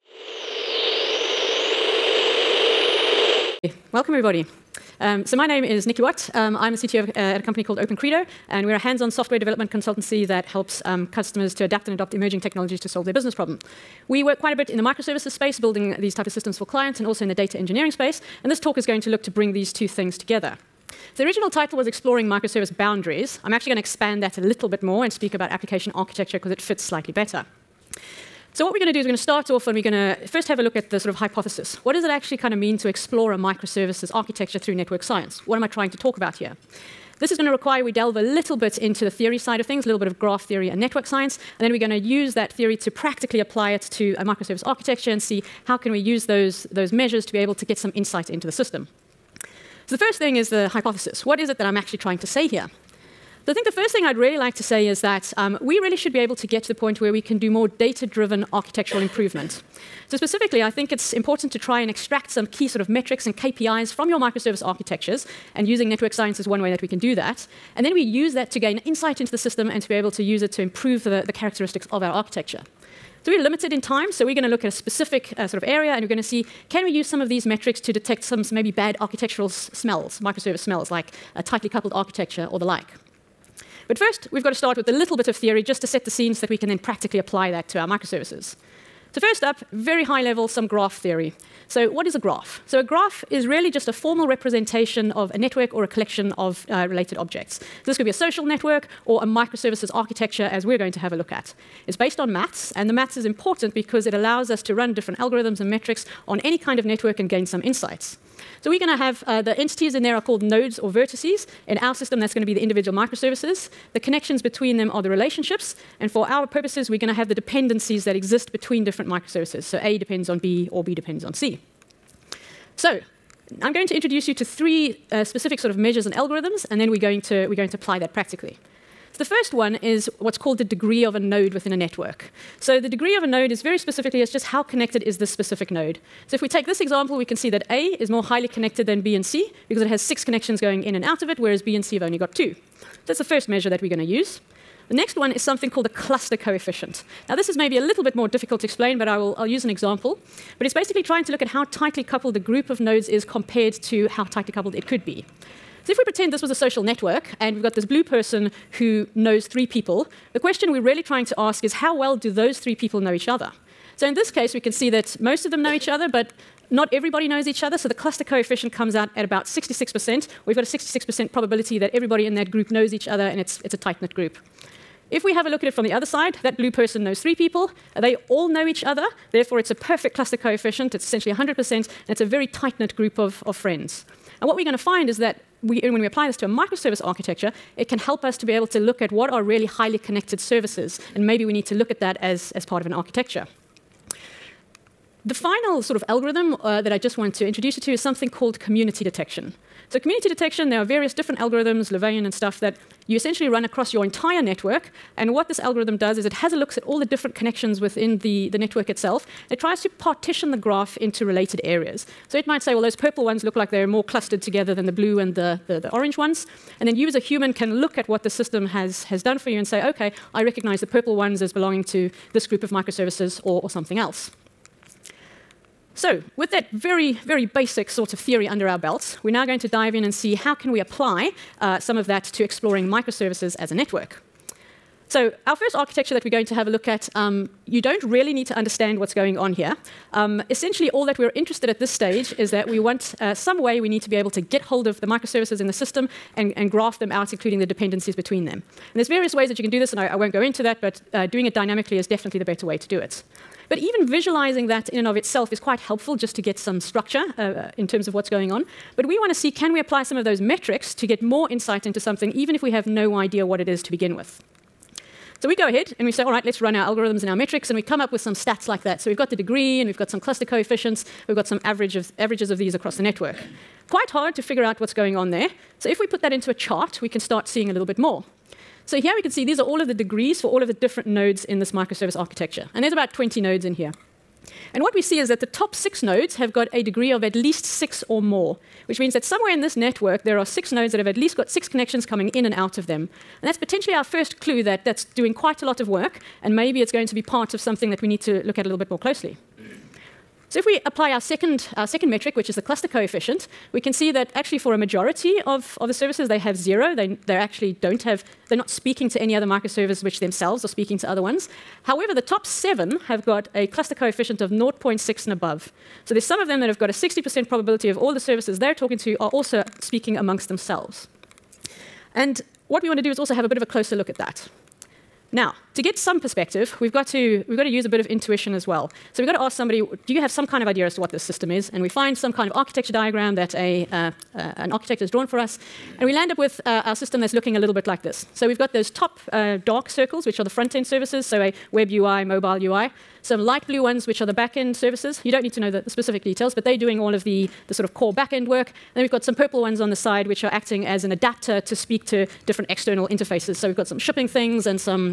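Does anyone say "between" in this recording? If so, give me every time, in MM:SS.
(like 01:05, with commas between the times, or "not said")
01:54, 01:58, 04:08.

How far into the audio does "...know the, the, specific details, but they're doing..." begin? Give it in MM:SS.
05:45.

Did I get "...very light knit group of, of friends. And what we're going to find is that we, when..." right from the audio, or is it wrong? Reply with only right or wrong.
wrong.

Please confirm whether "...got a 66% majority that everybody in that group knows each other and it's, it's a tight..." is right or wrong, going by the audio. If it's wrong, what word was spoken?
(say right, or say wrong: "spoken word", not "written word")
wrong: "probability", not "majority".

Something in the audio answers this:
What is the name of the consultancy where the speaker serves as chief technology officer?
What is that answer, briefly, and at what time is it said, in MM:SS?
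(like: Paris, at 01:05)
Open Credo, at 00:07.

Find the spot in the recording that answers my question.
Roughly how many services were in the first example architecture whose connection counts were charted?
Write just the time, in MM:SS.
04:43.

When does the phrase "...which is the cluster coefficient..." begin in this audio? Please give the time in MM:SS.
05:02.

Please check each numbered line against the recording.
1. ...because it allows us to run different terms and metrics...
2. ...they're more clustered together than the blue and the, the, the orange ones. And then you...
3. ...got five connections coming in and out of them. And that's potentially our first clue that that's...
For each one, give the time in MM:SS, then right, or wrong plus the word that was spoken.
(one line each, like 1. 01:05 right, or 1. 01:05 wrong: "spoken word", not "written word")
1. 01:43 wrong: "algorithms", not "terms"
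2. 03:33 right
3. 04:51 wrong: "six", not "five".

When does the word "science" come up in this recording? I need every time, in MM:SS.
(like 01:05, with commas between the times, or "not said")
00:35, 00:41, 01:06.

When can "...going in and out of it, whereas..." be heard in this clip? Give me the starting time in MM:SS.
02:20.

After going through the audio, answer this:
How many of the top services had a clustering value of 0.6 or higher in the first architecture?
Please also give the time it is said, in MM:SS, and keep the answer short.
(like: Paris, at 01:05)
7, at 05:12.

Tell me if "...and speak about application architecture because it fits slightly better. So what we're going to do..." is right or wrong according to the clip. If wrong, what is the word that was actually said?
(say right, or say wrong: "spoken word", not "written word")
right.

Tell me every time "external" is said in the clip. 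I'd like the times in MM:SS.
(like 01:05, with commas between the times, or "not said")
05:52.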